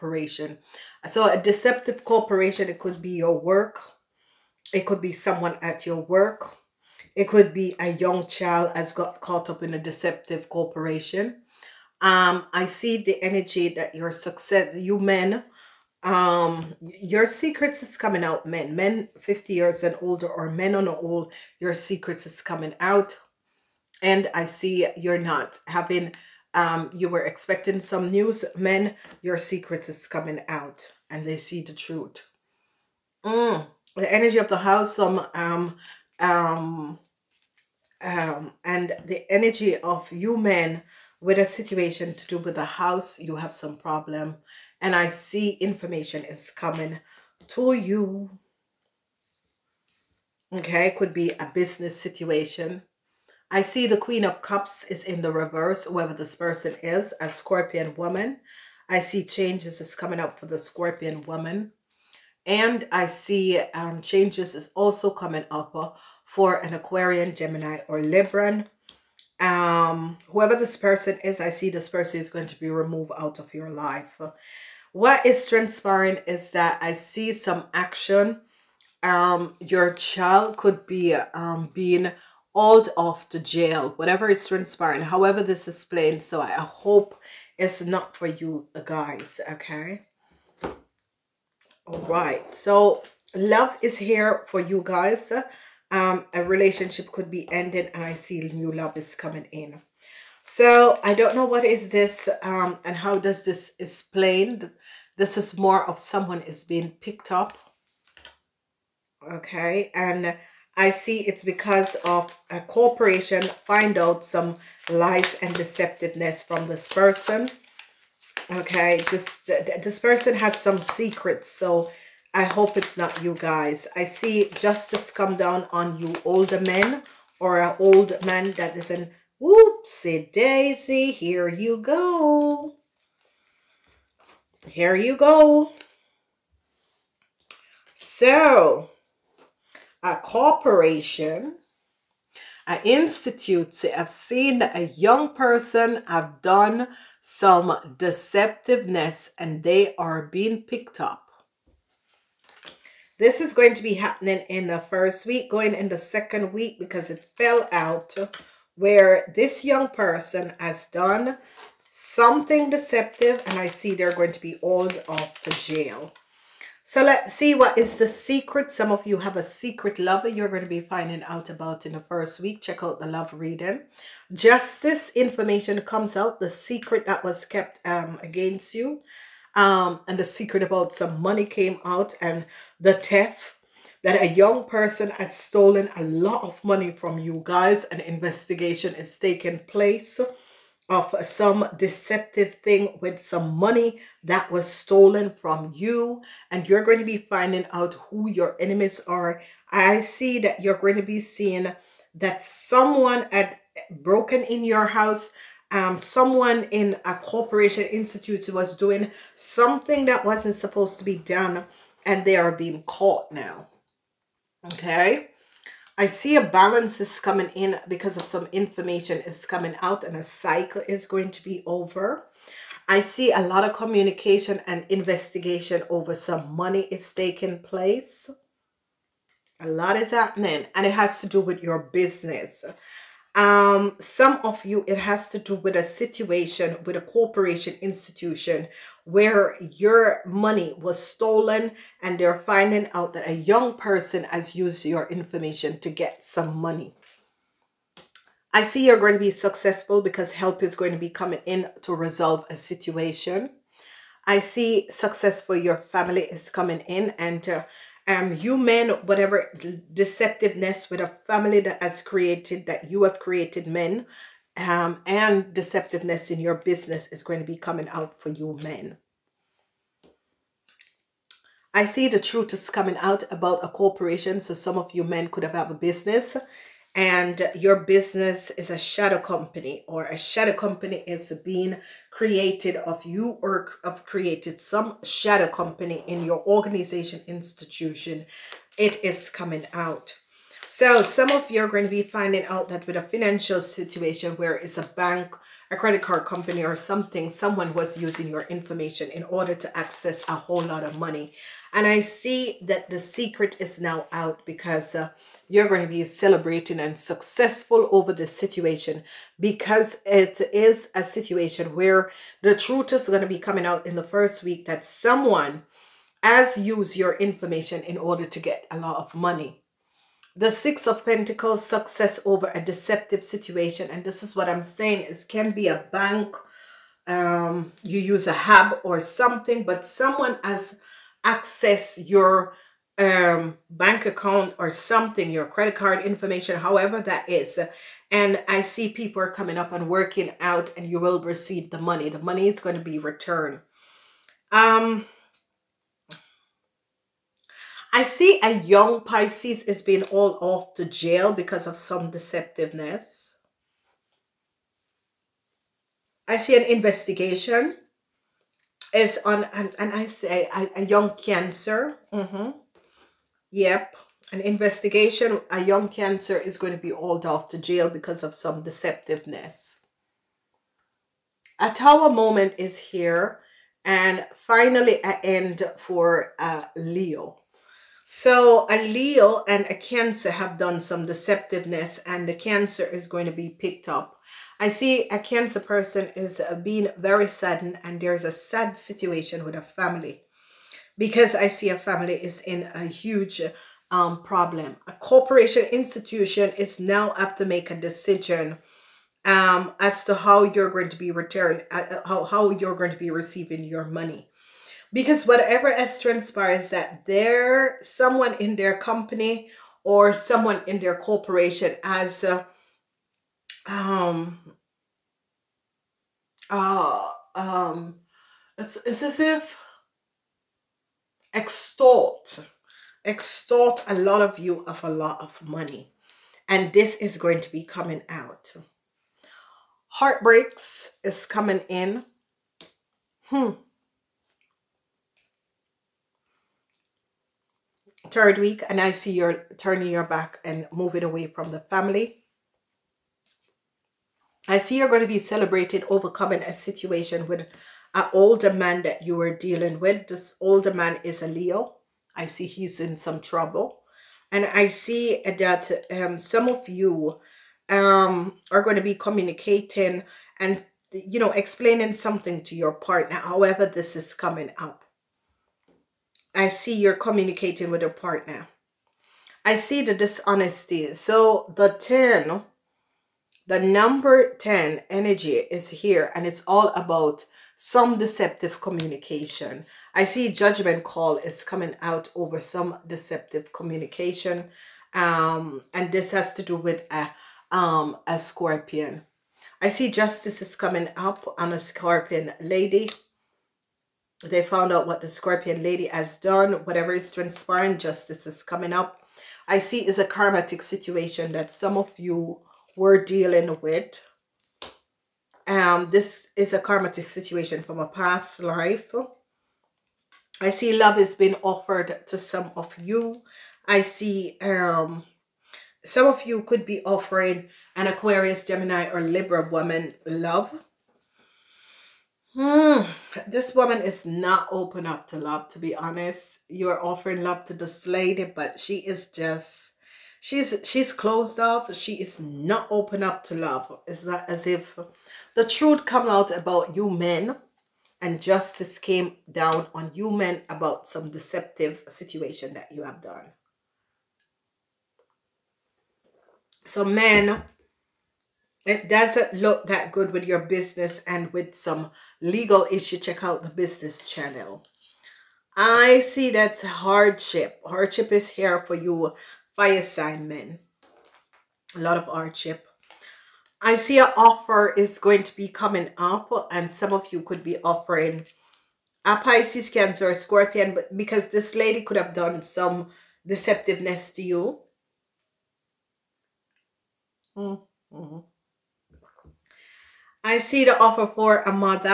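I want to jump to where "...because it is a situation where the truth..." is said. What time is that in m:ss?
5:09.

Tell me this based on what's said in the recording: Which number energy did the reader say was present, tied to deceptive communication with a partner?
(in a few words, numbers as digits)
10.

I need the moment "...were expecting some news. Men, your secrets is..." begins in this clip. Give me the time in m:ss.
0:27.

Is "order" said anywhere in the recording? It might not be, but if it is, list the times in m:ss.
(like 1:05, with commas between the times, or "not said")
4:59, 5:17.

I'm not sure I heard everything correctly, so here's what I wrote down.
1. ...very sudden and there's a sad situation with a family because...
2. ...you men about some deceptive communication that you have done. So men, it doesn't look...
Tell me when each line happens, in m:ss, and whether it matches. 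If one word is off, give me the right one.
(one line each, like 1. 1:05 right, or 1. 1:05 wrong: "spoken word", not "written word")
1. 6:26 right
2. 8:59 wrong: "situation", not "communication".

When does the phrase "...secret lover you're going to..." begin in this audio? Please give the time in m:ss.
2:49.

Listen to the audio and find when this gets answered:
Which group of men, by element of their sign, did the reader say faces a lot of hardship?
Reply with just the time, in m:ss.
9:19.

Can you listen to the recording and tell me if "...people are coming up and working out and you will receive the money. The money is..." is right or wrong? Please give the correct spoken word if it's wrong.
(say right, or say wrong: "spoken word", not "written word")
right.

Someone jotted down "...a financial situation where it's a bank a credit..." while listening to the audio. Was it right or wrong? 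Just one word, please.
right.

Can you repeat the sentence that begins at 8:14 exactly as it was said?
They found out what the scorpion lady has done.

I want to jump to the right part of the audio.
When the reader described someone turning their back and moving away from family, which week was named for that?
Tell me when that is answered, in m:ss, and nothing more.
7:18.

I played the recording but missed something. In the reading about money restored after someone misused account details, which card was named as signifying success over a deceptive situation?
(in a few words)
Six of Pentacles.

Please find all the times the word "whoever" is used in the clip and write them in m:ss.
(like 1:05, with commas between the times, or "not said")
0:55, 1:10.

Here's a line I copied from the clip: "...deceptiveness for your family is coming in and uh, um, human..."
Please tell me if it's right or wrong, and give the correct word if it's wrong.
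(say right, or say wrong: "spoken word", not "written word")
wrong: "success", not "deceptiveness".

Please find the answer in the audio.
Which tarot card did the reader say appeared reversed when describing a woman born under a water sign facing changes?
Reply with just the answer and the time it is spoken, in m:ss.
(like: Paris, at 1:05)
Queen of Cups, at 0:53.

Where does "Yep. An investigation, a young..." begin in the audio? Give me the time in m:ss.
6:03.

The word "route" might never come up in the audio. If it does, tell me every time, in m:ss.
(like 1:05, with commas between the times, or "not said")
not said.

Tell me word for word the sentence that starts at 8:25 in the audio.
Um, this is a karmatic situation from a past life.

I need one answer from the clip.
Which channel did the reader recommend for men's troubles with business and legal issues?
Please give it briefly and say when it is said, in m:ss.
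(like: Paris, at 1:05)
The business channel, at 9:13.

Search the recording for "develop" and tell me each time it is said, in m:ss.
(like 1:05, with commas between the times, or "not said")
not said.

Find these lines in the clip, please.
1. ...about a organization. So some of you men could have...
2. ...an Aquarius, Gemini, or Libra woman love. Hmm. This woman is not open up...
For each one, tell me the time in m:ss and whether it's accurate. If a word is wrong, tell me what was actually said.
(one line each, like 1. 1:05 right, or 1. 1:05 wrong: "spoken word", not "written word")
1. 4:33 wrong: "corporation", not "organization"
2. 8:37 right.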